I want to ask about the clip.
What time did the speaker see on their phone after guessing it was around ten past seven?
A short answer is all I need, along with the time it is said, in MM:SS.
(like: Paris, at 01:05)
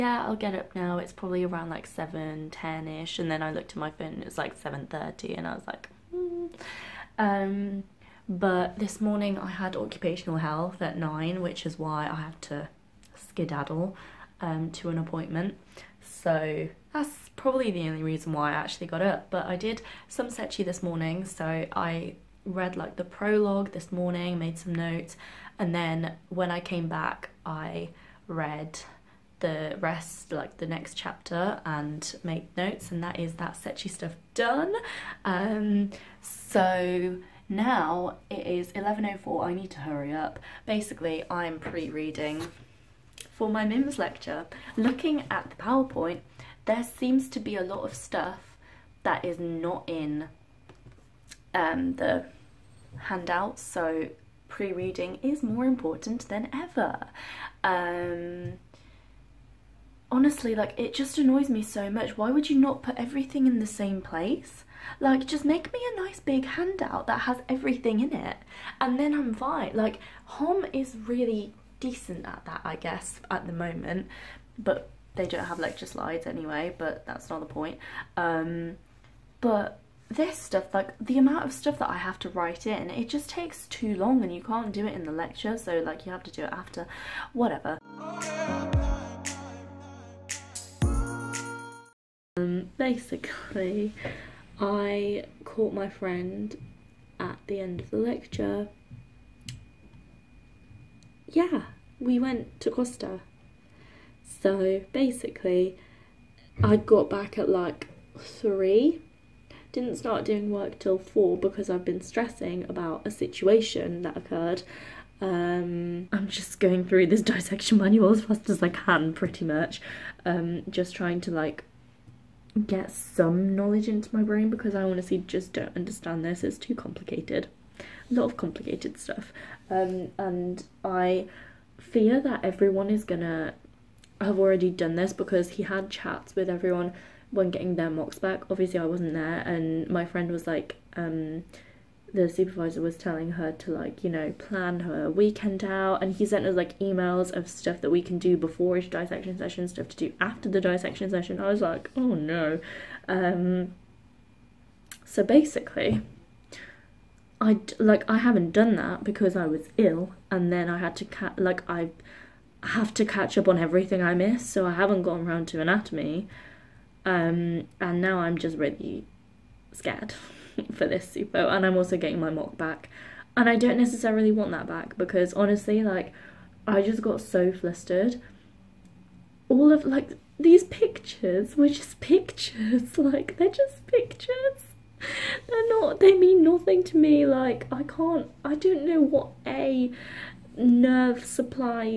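7:30, at 00:04.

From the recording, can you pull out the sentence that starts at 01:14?
But they don't have lecture slides anyway, but that's not the point.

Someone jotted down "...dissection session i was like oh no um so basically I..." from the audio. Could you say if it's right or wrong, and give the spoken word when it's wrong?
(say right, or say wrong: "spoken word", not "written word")
right.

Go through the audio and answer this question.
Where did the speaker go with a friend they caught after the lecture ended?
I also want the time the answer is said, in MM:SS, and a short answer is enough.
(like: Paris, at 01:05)
Costa, at 01:42.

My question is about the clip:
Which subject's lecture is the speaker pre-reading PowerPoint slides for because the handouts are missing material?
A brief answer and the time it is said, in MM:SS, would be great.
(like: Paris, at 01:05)
MIMS, at 00:43.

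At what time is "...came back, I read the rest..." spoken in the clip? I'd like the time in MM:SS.
00:26.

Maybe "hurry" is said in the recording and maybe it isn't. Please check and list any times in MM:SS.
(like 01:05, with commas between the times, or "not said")
00:39.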